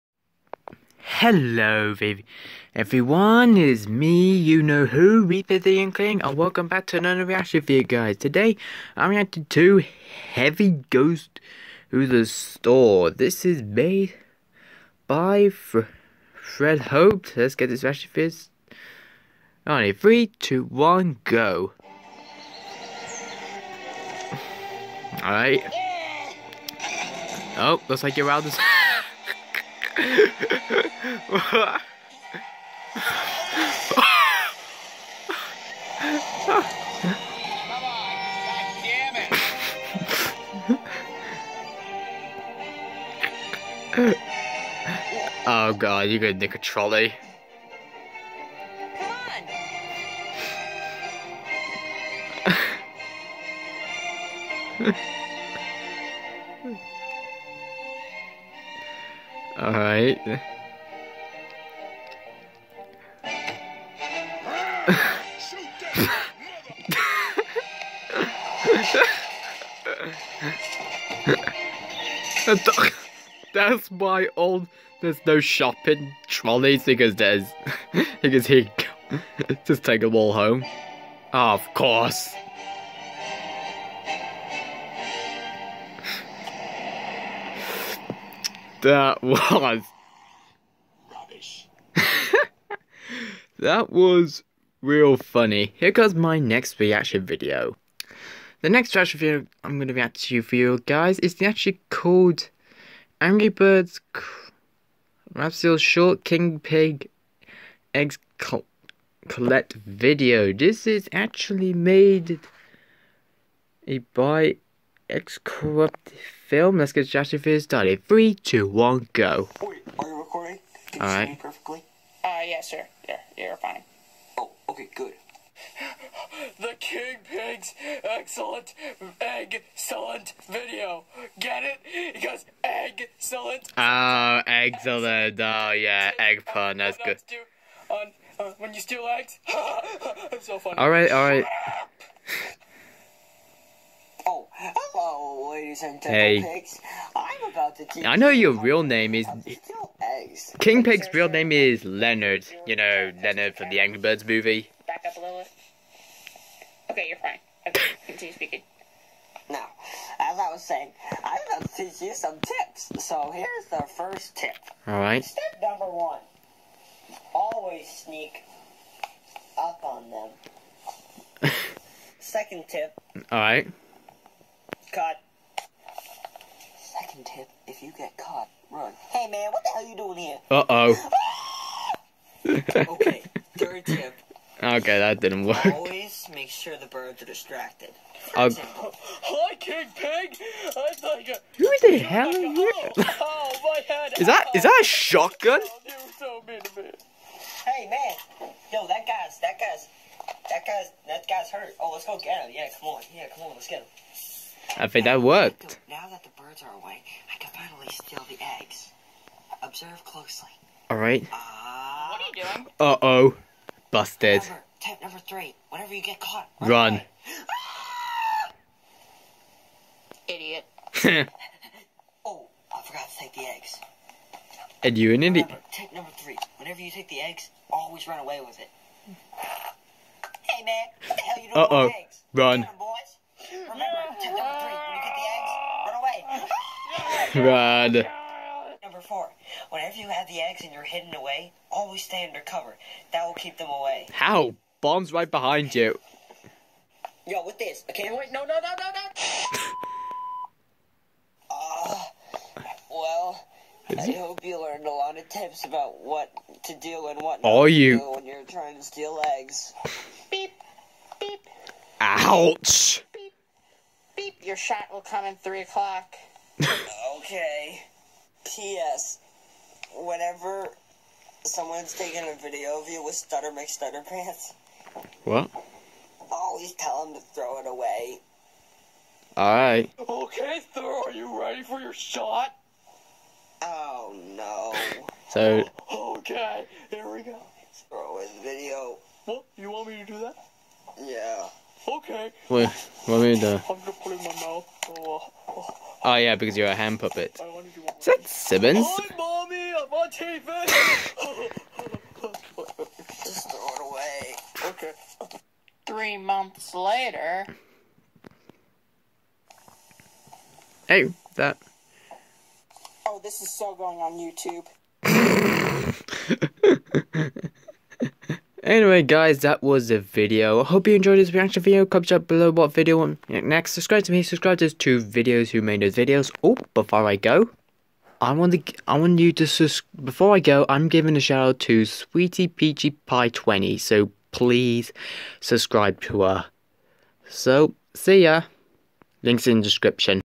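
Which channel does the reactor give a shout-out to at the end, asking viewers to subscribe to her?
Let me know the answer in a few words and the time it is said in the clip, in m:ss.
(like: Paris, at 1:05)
Sweetie Peachy Pie 20, at 5:31.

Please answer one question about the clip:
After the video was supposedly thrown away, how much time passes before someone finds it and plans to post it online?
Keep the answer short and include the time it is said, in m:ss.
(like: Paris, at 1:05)
Three months, at 5:05.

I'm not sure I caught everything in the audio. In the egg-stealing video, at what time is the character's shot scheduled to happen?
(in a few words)
3 o'clock.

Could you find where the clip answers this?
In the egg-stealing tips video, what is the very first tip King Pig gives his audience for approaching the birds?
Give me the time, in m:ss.
2:47.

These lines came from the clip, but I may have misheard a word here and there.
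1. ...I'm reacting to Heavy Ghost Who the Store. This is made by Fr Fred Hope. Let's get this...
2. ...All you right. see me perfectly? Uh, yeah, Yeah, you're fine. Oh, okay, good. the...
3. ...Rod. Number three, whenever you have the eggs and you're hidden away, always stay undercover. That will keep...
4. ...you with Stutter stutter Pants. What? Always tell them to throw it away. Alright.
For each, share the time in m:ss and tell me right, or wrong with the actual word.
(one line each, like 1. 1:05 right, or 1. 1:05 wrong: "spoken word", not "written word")
1. 0:08 right
2. 2:01 right
3. 3:58 wrong: "four", not "three"
4. 4:32 right.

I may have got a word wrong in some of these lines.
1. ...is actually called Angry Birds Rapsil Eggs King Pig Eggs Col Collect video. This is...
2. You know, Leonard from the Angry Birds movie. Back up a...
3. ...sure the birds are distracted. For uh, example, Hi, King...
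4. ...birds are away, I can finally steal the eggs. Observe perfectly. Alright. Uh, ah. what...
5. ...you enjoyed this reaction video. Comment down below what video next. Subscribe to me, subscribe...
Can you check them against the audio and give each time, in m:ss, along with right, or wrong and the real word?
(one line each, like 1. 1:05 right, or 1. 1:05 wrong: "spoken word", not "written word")
1. 1:41 wrong: "Short", not "Eggs"
2. 2:32 right
3. 3:06 right
4. 3:26 wrong: "closely", not "perfectly"
5. 5:20 right.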